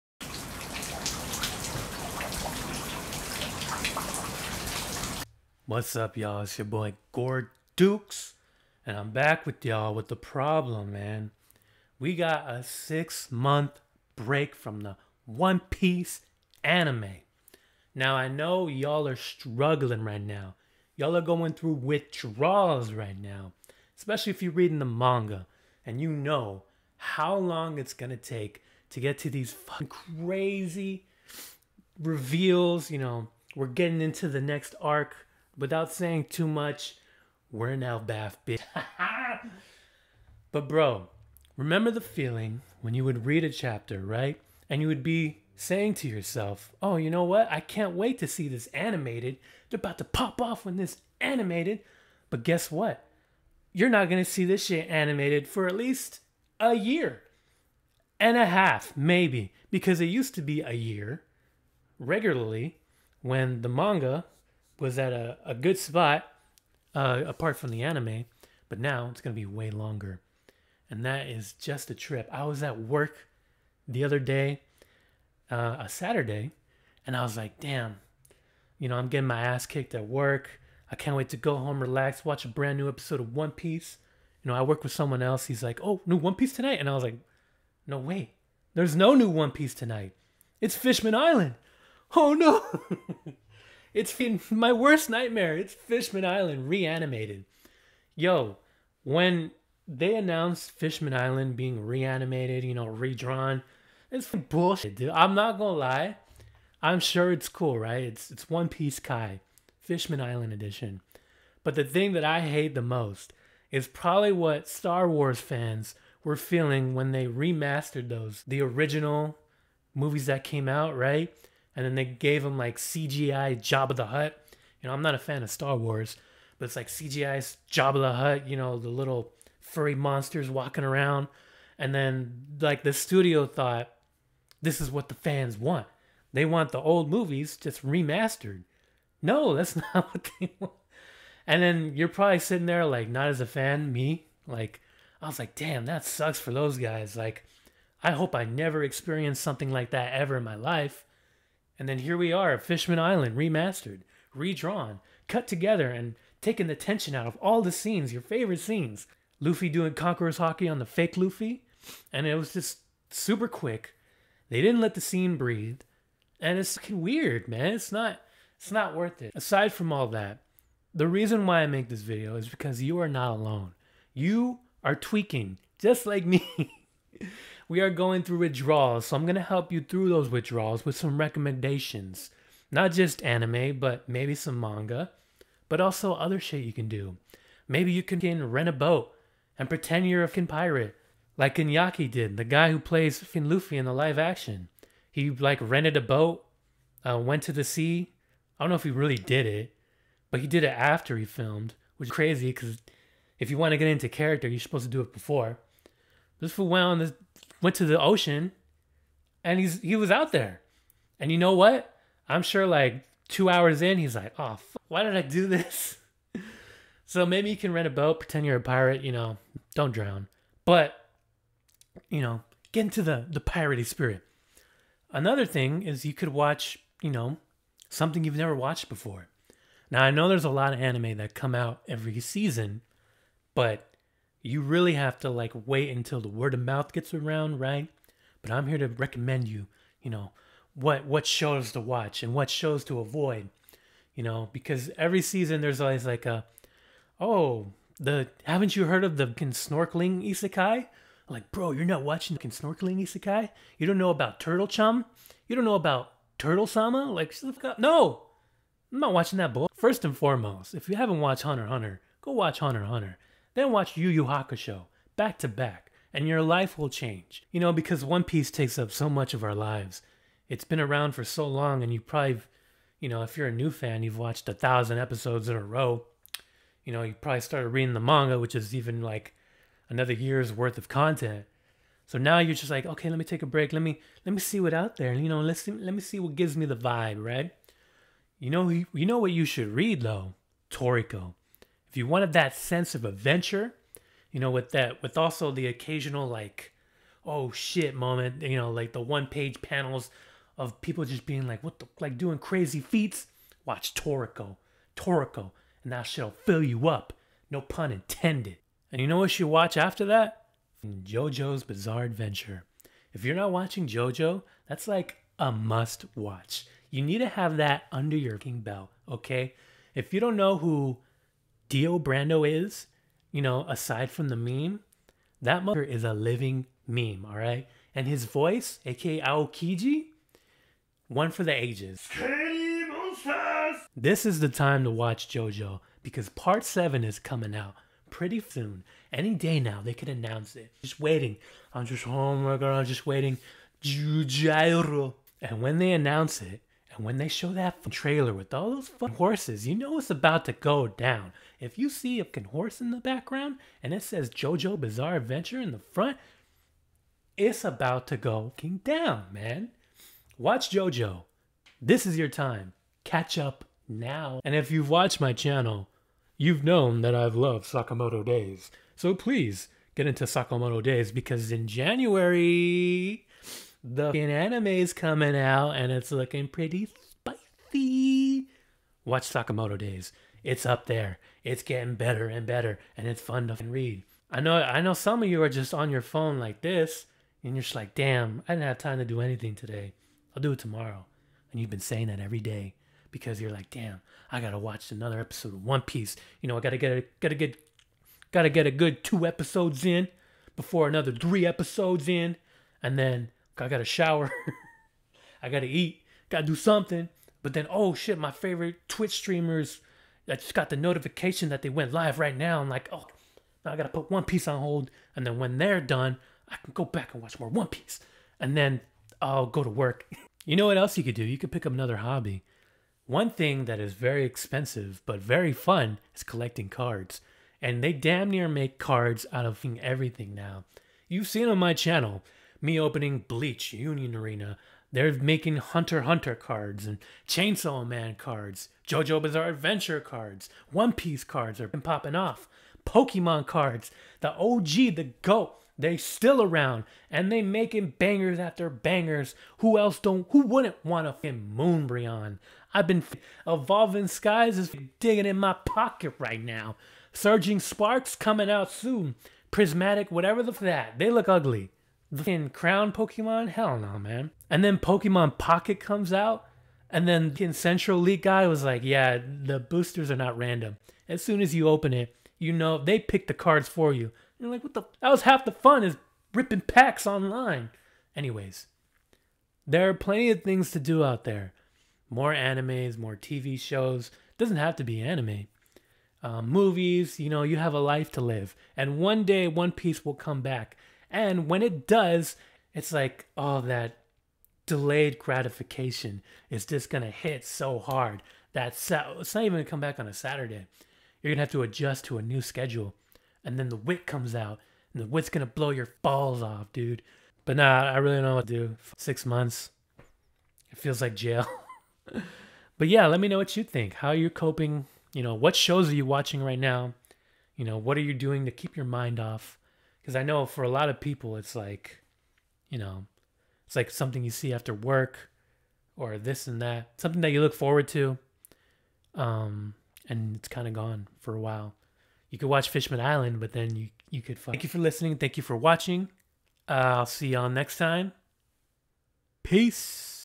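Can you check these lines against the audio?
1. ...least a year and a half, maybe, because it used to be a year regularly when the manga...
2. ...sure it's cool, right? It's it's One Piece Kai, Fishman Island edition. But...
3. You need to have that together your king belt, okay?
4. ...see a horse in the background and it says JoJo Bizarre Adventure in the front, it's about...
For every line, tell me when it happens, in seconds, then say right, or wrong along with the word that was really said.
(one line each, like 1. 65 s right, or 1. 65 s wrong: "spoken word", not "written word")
1. 55 s right
2. 106 s right
3. 316 s wrong: "under", not "together"
4. 351 s right.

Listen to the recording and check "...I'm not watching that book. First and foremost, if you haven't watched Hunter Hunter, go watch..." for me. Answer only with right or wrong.
right.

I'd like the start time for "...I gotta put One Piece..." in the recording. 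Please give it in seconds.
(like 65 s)
413 s.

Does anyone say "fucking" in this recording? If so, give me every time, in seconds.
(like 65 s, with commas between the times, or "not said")
166 s, 190 s, 462 s.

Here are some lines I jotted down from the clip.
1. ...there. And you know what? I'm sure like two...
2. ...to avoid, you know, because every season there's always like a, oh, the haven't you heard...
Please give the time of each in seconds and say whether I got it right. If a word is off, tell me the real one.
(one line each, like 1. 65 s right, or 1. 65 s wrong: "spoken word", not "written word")
1. 210 s right
2. 242 s right.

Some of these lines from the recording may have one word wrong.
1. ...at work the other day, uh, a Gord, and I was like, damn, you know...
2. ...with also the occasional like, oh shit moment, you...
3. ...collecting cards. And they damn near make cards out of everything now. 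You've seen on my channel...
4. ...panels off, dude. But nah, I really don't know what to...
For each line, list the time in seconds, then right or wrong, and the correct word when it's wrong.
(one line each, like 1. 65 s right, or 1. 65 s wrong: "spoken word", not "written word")
1. 72 s wrong: "Saturday", not "Gord"
2. 295 s right
3. 426 s right
4. 506 s wrong: "balls", not "panels".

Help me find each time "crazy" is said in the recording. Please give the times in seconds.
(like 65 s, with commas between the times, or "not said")
29 s, 202 s, 302 s.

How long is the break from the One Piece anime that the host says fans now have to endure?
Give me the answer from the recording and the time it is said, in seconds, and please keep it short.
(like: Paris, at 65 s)
6 months, at 12 s.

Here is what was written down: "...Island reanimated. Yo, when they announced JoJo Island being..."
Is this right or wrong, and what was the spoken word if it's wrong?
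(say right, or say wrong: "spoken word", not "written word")
wrong: "Fishman", not "JoJo".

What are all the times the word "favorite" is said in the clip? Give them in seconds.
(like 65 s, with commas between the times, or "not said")
158 s, 408 s.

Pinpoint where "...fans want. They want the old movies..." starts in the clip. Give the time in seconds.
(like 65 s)
135 s.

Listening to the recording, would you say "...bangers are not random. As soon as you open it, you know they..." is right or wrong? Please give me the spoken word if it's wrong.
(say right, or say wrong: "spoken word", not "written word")
wrong: "boosters", not "bangers".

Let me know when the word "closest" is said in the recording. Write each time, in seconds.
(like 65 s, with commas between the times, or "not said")
not said.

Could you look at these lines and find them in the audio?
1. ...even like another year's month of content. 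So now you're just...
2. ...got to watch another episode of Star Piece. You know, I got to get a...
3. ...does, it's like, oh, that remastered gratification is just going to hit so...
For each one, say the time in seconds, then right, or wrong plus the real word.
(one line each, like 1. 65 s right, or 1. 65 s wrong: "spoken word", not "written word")
1. 278 s wrong: "worth", not "month"
2. 394 s wrong: "One", not "Star"
3. 491 s wrong: "delayed", not "remastered".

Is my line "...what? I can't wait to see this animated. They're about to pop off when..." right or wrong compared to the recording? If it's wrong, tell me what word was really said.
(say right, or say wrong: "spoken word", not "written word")
right.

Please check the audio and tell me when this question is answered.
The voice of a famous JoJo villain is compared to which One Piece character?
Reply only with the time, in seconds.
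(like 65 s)
329 s.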